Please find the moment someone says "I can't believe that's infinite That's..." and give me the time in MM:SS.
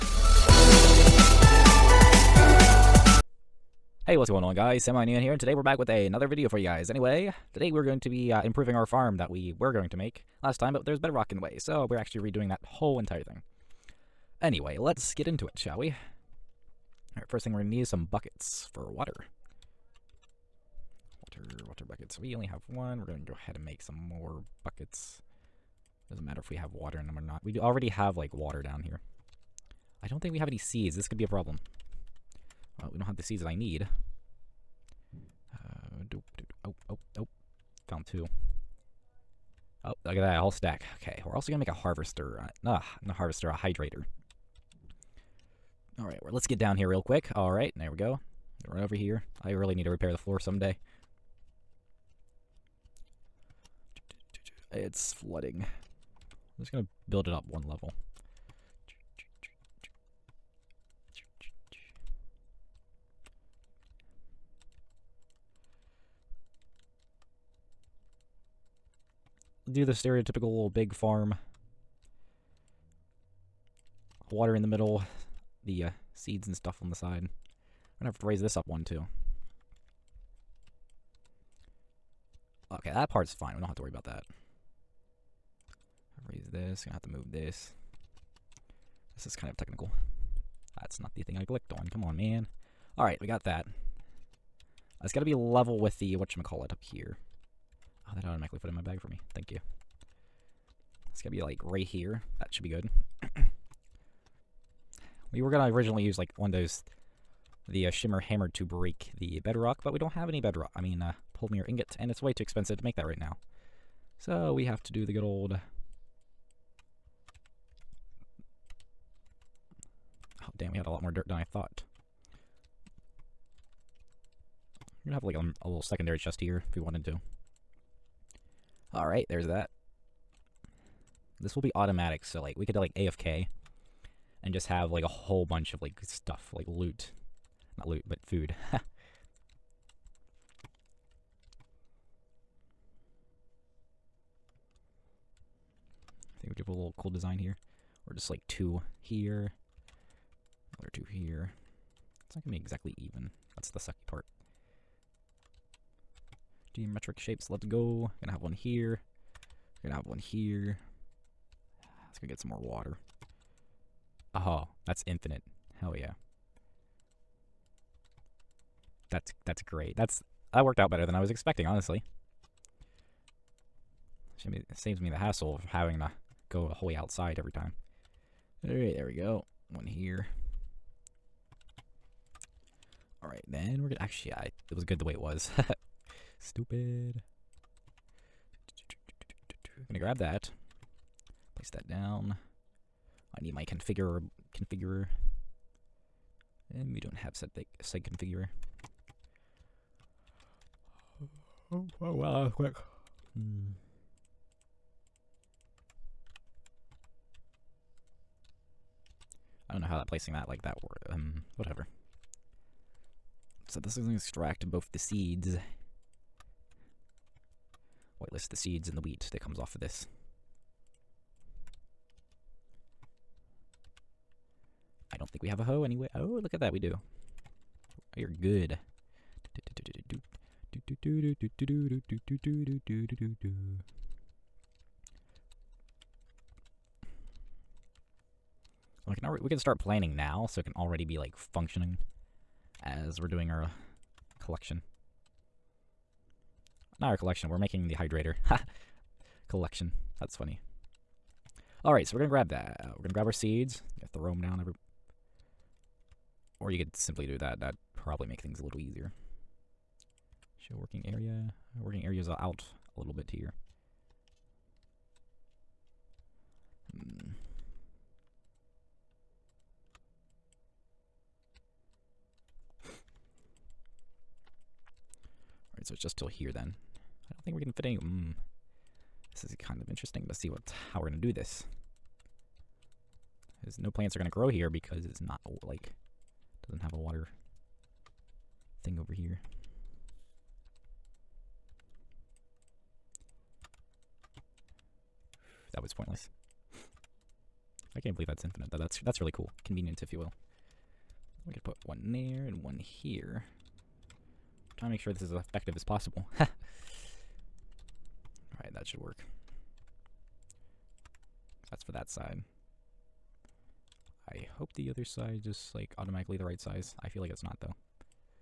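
04:57.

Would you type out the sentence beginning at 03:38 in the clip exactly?
Whitelist the seeds and the wheat that comes off of this.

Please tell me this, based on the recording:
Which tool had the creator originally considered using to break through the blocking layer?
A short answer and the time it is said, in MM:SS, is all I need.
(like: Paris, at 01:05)
Shimmer hammer, at 01:47.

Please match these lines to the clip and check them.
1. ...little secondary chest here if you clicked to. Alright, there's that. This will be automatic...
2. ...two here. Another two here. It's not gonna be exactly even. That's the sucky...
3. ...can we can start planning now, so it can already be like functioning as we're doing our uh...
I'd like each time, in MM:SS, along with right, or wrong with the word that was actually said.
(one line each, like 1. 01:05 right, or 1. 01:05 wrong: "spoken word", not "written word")
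1. 02:05 wrong: "wanted", not "clicked"
2. 02:28 right
3. 03:59 right.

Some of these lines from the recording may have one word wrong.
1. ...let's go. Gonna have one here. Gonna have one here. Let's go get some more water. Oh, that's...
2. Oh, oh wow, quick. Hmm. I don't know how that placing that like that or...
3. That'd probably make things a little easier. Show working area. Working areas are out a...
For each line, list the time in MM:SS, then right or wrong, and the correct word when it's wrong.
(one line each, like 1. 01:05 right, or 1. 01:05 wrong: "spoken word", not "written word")
1. 02:37 right
2. 03:21 right
3. 04:17 right.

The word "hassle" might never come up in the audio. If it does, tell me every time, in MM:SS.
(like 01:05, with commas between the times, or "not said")
02:55.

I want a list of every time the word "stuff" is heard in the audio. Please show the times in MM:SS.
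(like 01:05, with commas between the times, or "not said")
01:16, 02:16.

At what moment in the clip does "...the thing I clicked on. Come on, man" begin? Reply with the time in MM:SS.
01:31.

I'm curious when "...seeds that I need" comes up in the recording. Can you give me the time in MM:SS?
00:33.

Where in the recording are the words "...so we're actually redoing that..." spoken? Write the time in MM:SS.
00:11.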